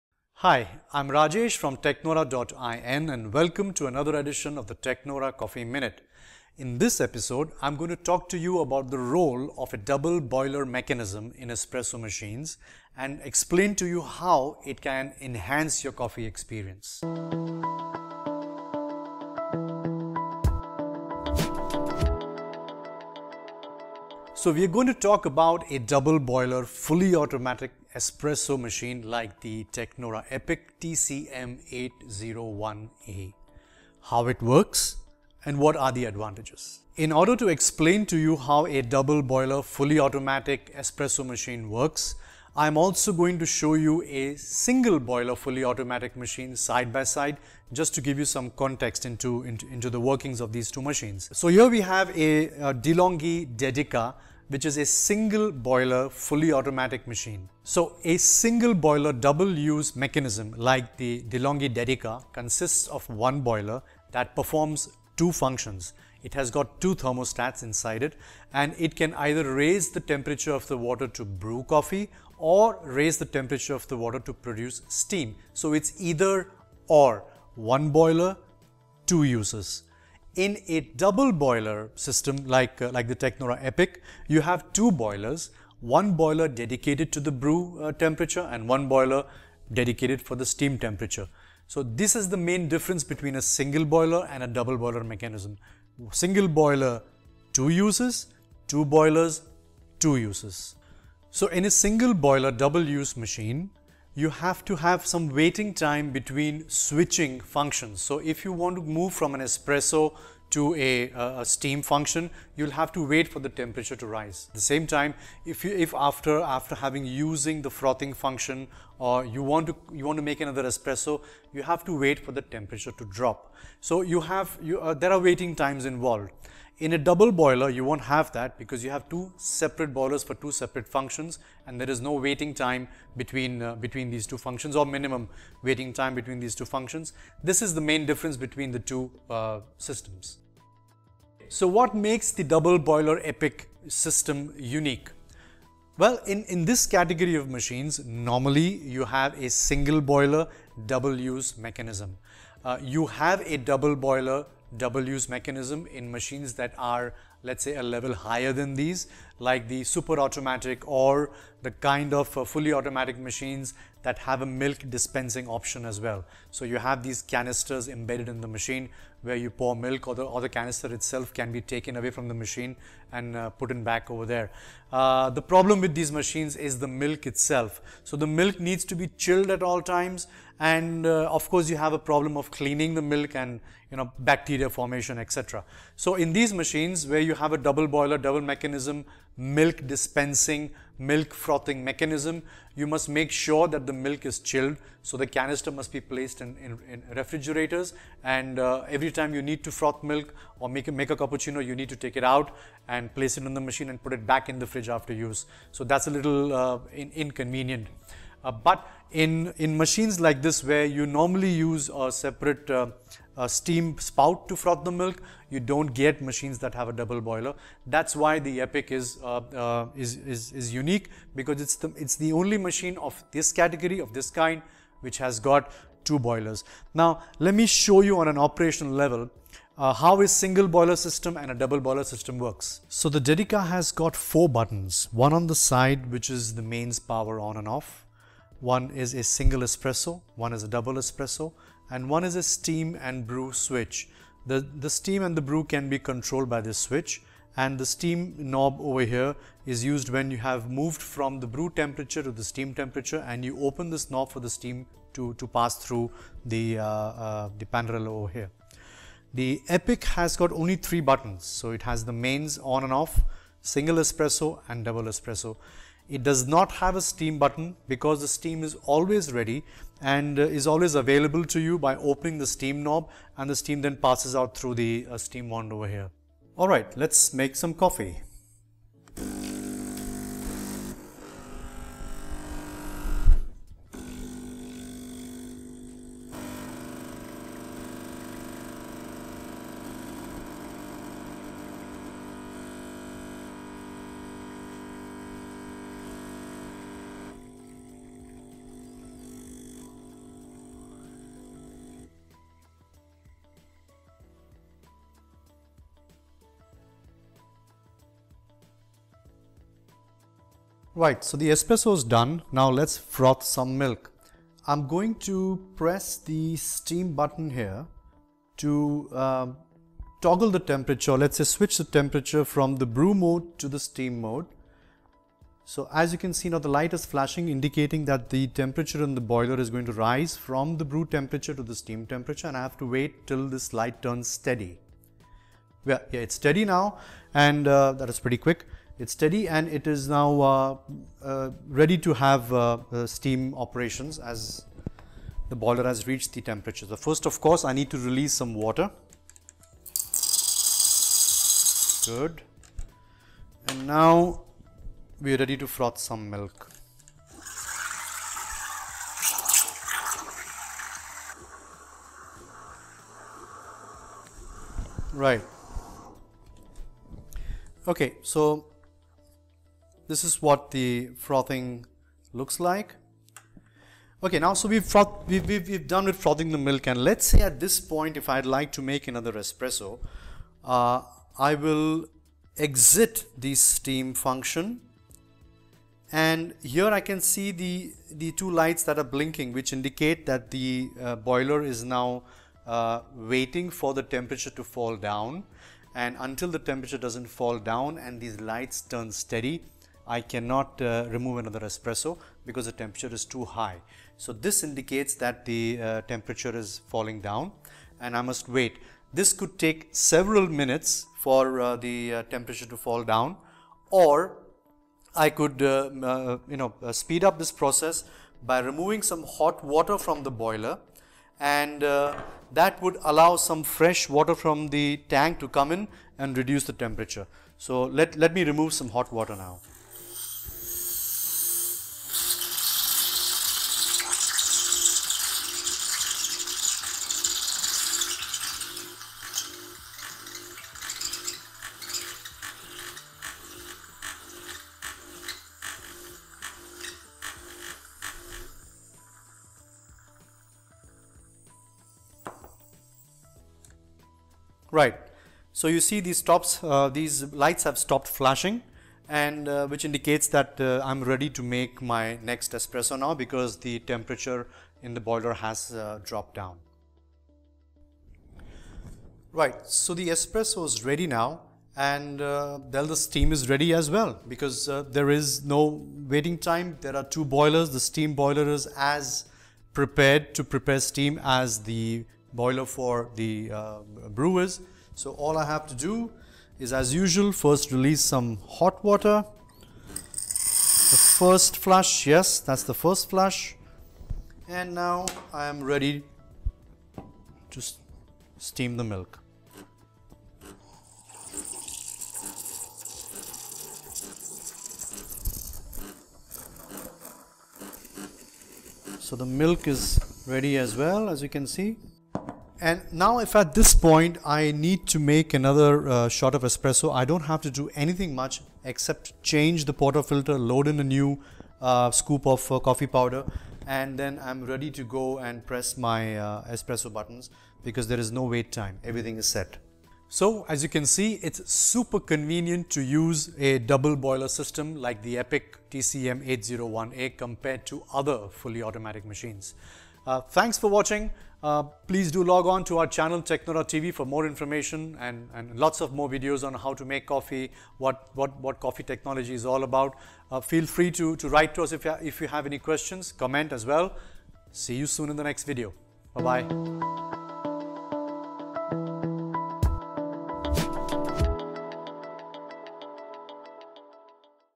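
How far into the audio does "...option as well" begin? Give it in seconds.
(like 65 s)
165 s.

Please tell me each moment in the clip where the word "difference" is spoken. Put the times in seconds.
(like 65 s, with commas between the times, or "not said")
92 s, 138 s.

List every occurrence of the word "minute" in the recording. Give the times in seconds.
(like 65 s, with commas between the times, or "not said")
5 s, 410 s.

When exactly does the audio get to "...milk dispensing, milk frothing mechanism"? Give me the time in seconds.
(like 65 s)
189 s.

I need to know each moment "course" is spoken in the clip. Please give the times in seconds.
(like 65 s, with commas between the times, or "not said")
181 s, 347 s.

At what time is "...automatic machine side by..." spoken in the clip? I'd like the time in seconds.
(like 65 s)
45 s.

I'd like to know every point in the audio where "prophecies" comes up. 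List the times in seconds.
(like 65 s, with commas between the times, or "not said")
not said.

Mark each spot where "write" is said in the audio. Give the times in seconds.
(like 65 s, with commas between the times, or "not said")
551 s.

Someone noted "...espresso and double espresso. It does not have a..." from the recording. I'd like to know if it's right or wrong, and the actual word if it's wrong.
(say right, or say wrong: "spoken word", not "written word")
right.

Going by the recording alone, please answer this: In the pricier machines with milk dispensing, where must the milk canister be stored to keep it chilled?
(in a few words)
Refrigerators.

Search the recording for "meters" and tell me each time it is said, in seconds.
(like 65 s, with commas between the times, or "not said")
not said.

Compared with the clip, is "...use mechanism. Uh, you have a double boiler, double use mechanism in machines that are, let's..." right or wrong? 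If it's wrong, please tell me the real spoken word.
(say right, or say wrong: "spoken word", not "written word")
right.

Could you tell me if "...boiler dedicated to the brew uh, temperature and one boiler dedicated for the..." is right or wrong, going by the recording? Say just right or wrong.
right.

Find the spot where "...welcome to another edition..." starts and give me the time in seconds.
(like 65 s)
3 s.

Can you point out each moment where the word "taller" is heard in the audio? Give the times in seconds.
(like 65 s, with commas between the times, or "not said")
not said.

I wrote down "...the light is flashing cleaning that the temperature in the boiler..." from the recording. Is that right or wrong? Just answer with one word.
wrong.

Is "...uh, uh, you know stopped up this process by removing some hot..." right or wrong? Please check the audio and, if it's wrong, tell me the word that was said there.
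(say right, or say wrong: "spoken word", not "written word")
wrong: "speed", not "stopped".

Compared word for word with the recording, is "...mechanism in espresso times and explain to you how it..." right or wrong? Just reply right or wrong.
wrong.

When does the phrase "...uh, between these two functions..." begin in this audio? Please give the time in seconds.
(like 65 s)
133 s.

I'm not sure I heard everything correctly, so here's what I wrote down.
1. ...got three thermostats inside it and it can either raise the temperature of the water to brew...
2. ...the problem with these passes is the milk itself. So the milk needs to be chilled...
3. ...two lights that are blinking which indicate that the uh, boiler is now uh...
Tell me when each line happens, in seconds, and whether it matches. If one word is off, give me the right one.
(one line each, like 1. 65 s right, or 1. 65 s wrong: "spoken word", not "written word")
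1. 66 s wrong: "two", not "three"
2. 175 s wrong: "machines", not "passes"
3. 388 s right.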